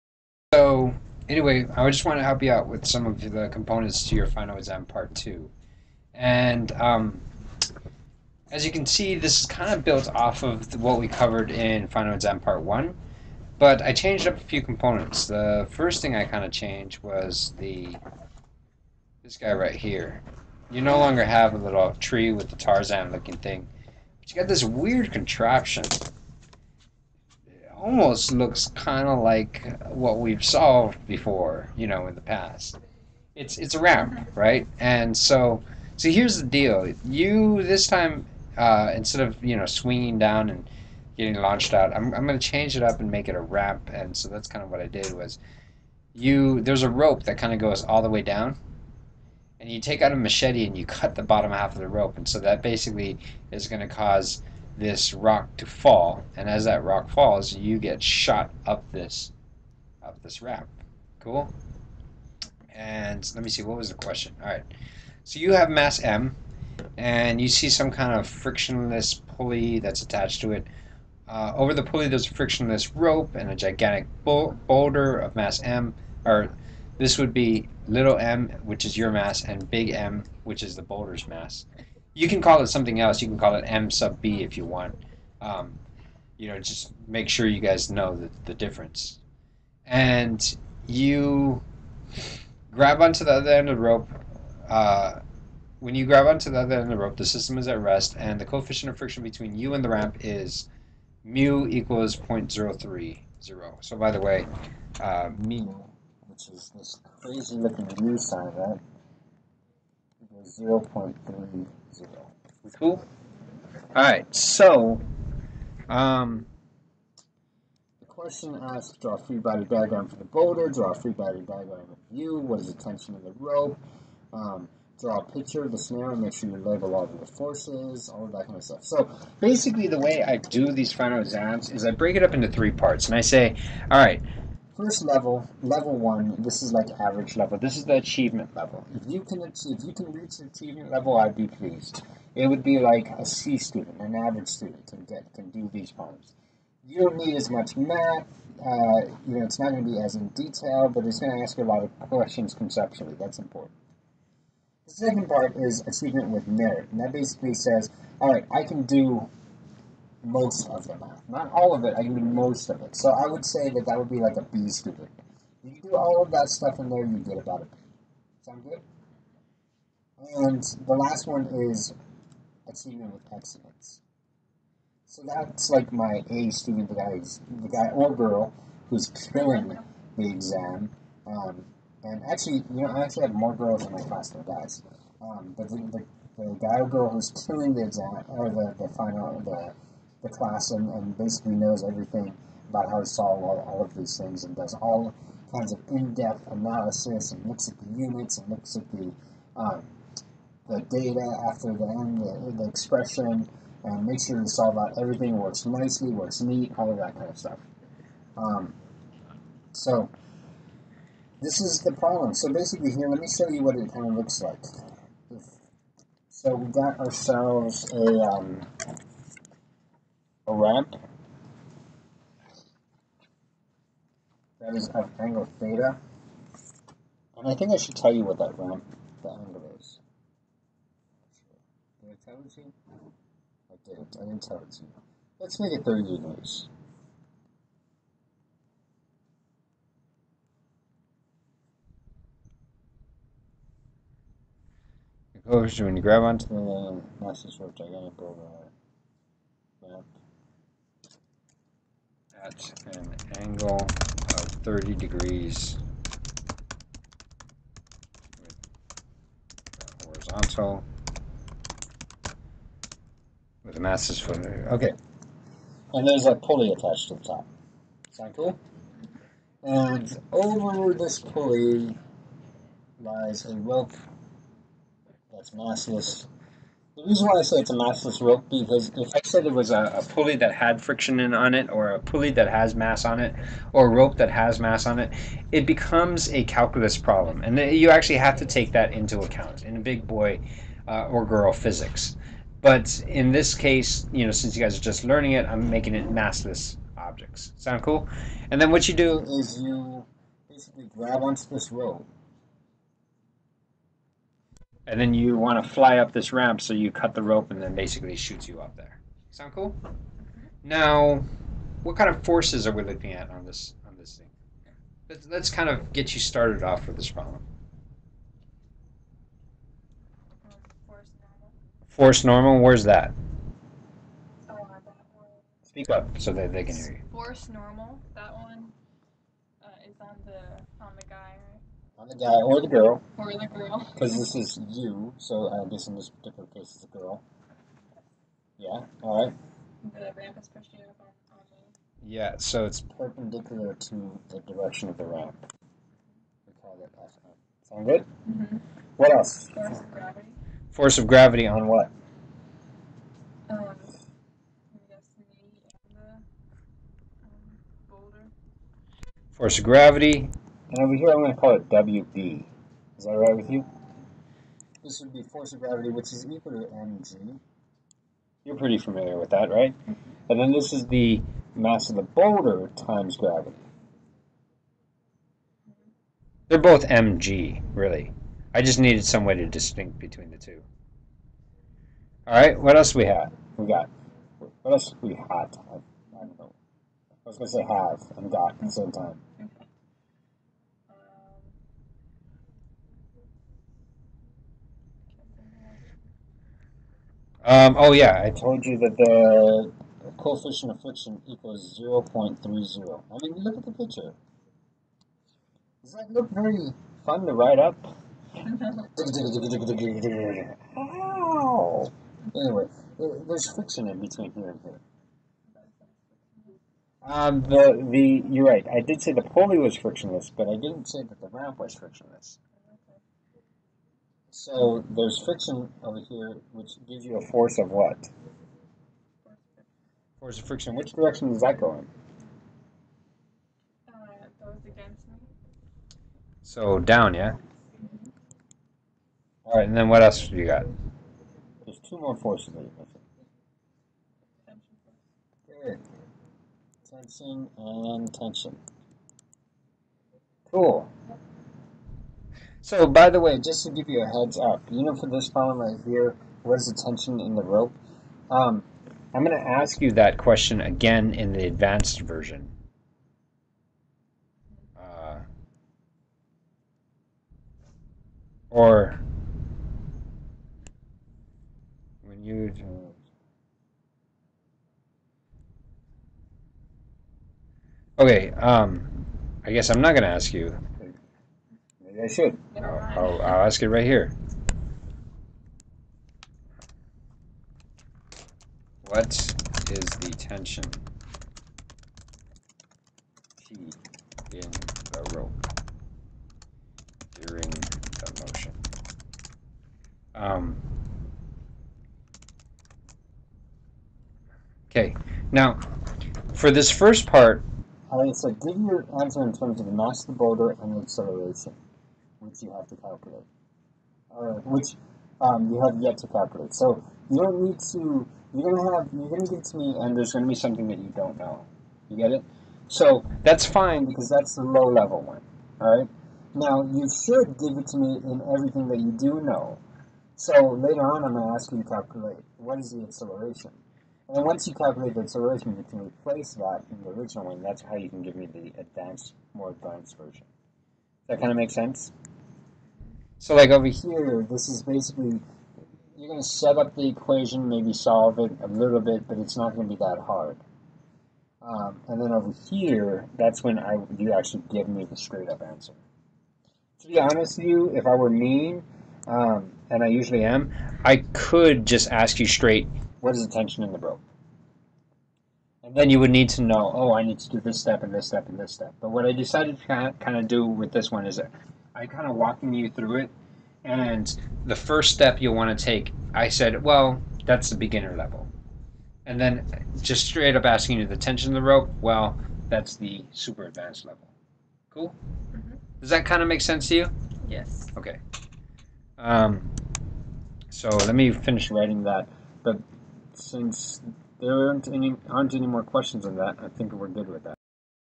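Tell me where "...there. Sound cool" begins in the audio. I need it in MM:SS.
05:08.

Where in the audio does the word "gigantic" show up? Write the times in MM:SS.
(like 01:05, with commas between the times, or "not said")
01:13, 04:07.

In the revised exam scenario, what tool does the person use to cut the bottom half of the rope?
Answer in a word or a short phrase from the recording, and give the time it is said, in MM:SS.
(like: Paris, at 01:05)
machete, at 00:50.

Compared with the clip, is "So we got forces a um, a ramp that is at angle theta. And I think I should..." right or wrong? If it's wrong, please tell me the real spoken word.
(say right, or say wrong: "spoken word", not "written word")
wrong: "ourselves", not "forces".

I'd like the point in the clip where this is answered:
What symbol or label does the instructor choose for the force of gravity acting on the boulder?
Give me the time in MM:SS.
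06:01.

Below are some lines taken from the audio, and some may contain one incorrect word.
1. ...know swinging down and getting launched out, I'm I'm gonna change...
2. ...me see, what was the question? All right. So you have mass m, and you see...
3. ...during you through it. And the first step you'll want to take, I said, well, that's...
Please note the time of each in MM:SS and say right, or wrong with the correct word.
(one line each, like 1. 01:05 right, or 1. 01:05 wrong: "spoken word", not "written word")
1. 00:39 right
2. 01:03 right
3. 09:32 wrong: "walking", not "during".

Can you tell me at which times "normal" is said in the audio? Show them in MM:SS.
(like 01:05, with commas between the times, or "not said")
05:22, 05:27.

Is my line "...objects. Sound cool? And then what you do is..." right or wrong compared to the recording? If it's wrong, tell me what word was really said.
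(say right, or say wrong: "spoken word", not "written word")
right.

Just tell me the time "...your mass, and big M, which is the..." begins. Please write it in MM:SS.
01:18.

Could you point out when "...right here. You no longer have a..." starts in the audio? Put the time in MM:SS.
00:19.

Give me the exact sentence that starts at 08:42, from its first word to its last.
So that's fine because that's the low level one.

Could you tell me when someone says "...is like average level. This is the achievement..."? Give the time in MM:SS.
02:16.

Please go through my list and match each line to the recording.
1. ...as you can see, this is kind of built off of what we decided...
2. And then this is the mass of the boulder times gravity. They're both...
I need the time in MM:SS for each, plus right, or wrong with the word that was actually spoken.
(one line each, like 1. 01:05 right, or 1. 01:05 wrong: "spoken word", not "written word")
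1. 00:08 wrong: "covered", not "decided"
2. 06:10 right.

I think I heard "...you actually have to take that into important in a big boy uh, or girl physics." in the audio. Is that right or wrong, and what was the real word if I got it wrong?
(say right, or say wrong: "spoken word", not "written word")
wrong: "account", not "important".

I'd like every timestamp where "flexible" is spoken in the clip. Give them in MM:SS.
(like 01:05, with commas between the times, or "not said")
not said.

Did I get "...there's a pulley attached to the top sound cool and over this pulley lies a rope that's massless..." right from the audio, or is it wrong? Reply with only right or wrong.
right.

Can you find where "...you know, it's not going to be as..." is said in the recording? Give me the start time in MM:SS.
02:29.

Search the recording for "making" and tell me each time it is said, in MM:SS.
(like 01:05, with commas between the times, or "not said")
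04:55.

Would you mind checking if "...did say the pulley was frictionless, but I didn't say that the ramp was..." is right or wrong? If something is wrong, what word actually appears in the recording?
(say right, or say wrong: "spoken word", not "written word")
right.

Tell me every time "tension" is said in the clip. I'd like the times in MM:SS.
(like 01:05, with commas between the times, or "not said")
02:02, 07:28, 07:36, 08:10, 09:23, 09:40.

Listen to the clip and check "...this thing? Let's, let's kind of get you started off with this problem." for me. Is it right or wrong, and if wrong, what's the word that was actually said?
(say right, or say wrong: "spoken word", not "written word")
right.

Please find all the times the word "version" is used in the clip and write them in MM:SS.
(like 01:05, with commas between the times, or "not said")
07:42, 08:59.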